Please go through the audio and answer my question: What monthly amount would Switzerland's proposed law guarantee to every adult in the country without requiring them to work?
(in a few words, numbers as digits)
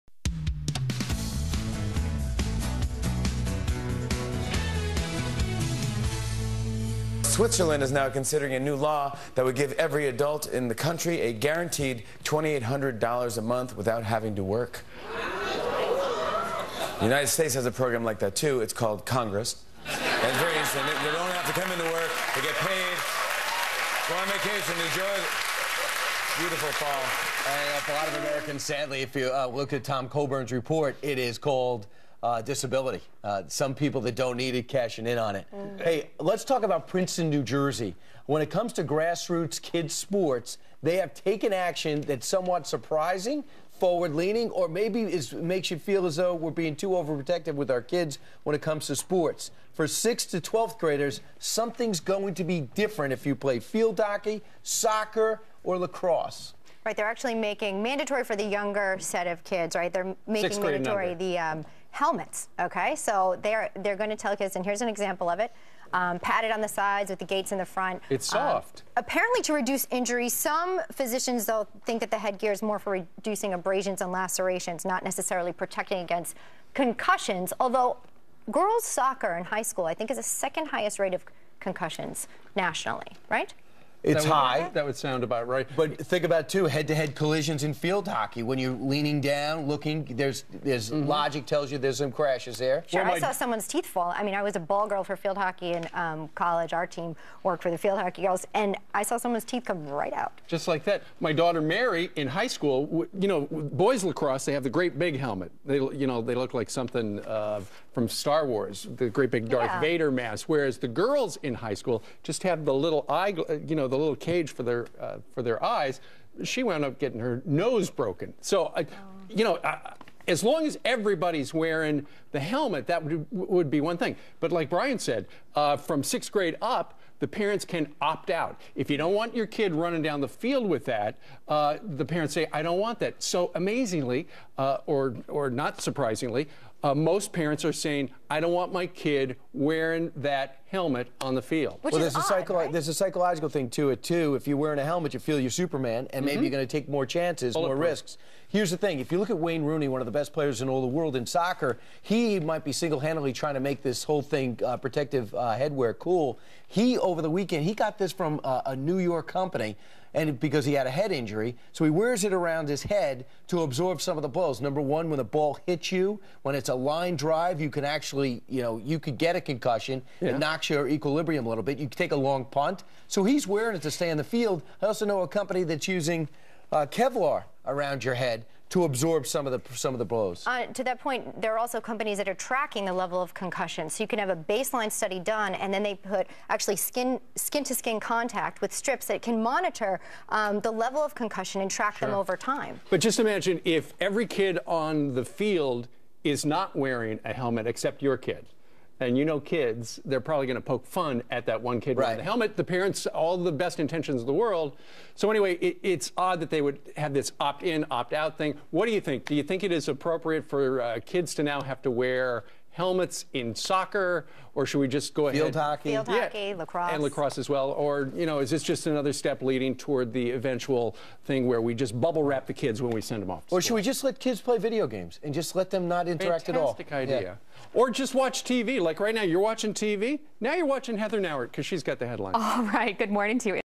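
$2,800.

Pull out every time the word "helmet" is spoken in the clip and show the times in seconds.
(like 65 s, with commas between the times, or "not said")
61 s, 105 s, 122 s, 140 s, 144 s, 197 s, 202 s, 212 s.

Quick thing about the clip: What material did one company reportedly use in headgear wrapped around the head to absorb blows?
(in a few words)
Kevlar.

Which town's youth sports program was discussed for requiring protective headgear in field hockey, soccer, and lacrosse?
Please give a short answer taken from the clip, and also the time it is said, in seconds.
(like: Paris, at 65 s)
Princeton, New Jersey, at 36 s.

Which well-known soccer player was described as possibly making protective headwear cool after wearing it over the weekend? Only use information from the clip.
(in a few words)
Wayne Rooney.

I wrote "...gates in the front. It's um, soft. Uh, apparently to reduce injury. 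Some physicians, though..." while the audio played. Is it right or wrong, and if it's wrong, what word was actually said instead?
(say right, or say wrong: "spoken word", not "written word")
right.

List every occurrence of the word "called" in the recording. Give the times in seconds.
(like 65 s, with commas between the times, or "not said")
18 s, 31 s.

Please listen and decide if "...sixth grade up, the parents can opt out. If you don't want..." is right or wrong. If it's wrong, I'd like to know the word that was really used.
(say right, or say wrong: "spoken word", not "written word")
right.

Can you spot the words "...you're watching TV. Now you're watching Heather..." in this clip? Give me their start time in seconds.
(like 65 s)
229 s.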